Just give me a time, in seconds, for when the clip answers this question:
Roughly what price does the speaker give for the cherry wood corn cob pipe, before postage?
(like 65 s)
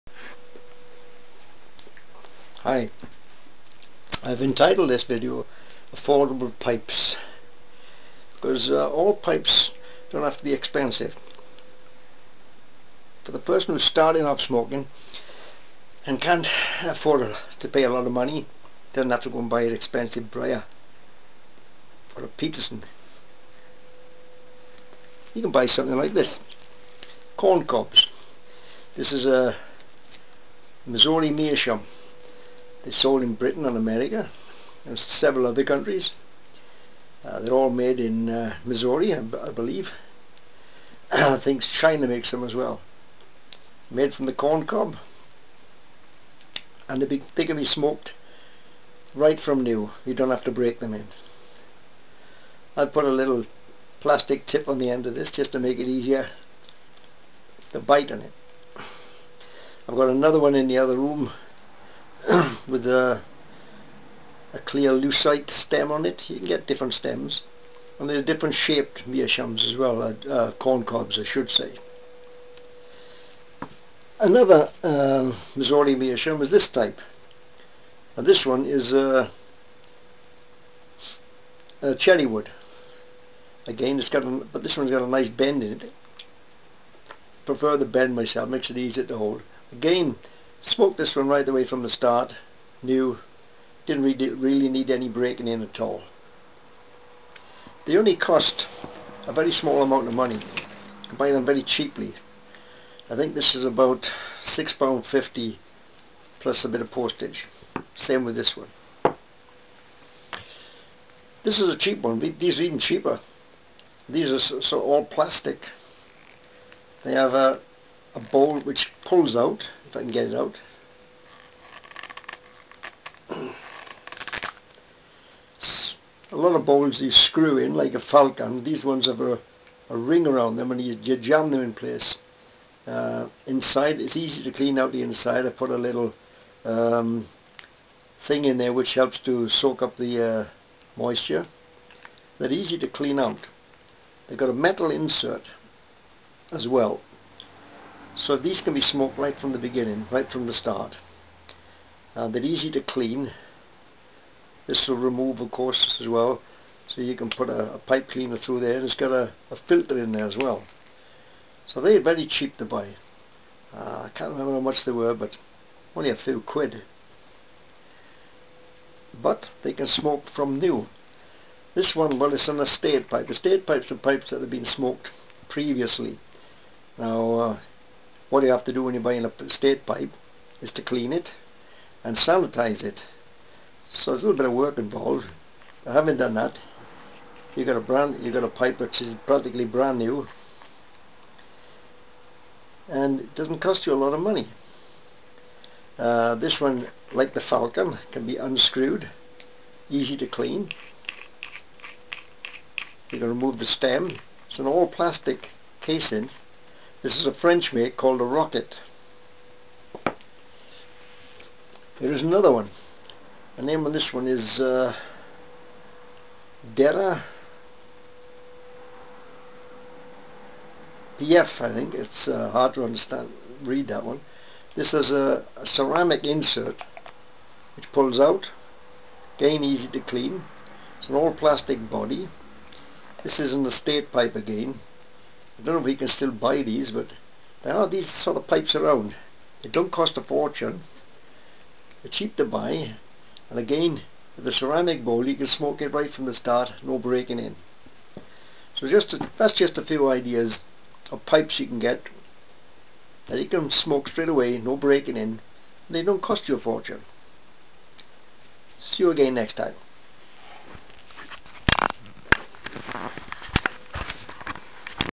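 104 s.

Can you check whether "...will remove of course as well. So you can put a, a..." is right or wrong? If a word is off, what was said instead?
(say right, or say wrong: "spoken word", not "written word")
right.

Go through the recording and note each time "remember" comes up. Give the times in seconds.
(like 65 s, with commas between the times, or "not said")
164 s.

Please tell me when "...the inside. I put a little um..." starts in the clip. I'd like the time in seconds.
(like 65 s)
134 s.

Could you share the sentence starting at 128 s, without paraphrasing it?
These ones have a, a ring around them and you, you jam them in place.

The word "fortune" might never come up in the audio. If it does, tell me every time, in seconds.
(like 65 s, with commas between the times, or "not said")
240 s, 256 s.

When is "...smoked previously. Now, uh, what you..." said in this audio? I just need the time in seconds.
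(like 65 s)
174 s.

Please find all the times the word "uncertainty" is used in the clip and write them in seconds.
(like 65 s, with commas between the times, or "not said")
not said.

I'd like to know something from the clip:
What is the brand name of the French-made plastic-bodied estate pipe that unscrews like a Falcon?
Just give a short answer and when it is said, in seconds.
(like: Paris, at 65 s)
Rocket, at 208 s.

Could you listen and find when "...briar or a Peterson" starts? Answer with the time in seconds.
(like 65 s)
20 s.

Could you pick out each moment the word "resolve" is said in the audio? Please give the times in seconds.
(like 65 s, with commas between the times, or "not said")
not said.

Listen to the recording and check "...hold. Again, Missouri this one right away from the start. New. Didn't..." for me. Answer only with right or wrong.
wrong.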